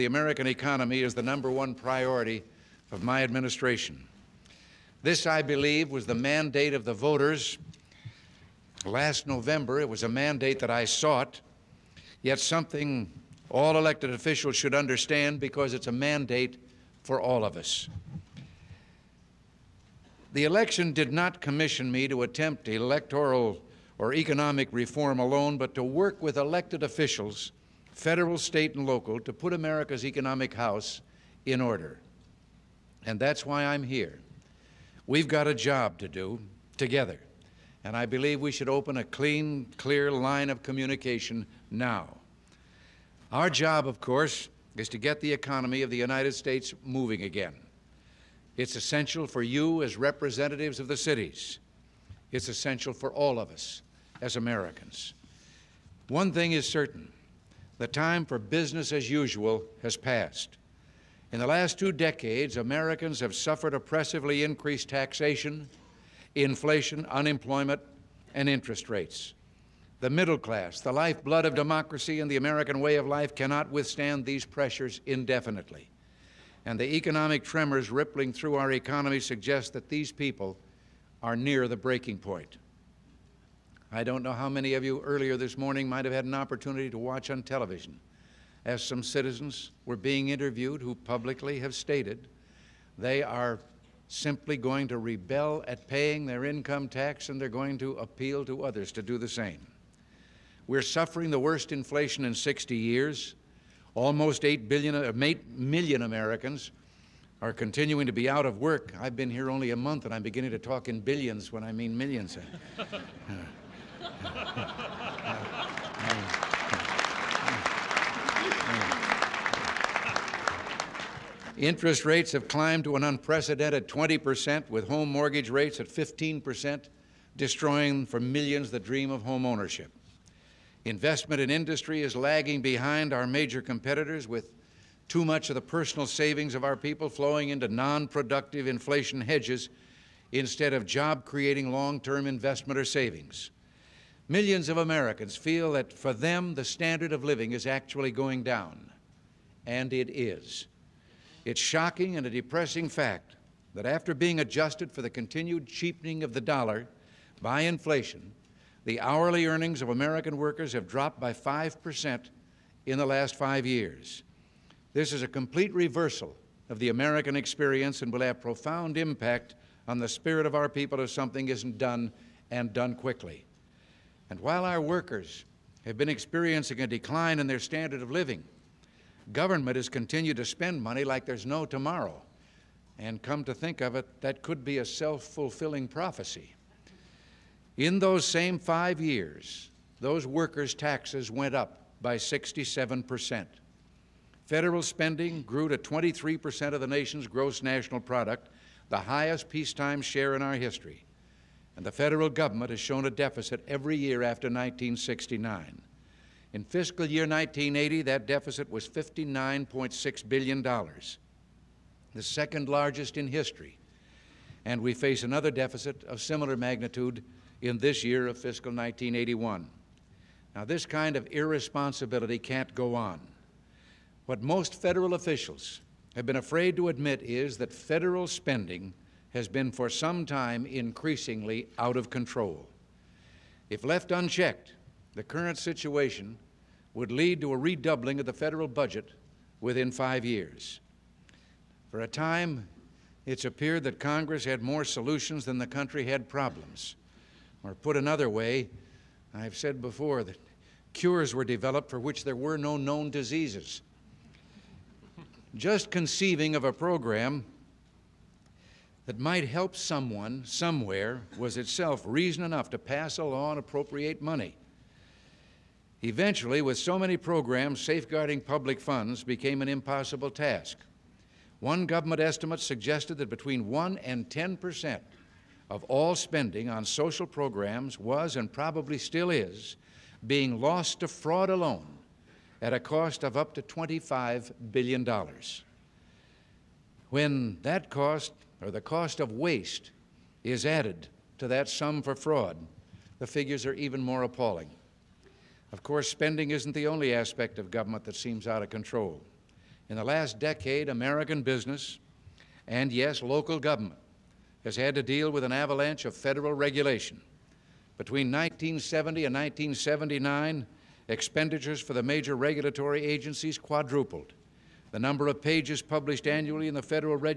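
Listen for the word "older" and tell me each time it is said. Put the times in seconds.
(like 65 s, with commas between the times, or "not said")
not said.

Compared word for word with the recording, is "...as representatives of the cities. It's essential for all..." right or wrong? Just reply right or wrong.
right.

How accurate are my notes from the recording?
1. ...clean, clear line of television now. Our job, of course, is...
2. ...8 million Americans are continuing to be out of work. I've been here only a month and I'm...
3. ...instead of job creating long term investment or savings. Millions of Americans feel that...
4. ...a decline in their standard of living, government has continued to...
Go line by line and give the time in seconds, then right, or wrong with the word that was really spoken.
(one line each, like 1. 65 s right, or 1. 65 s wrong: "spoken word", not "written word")
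1. 39 s wrong: "communication", not "television"
2. 105 s right
3. 140 s right
4. 176 s right.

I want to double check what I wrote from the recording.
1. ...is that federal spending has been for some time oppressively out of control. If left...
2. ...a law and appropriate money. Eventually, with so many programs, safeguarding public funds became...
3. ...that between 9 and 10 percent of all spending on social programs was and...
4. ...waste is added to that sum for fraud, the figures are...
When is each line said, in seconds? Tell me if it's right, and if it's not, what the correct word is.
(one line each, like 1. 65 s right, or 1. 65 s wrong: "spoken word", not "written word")
1. 227 s wrong: "increasingly", not "oppressively"
2. 263 s right
3. 273 s wrong: "1", not "9"
4. 289 s right.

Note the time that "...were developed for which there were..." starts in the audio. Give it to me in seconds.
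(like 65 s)
251 s.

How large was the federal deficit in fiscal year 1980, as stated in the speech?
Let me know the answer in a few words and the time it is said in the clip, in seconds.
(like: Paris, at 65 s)
$59.6 billion, at 208 s.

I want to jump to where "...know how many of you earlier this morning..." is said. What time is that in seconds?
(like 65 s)
84 s.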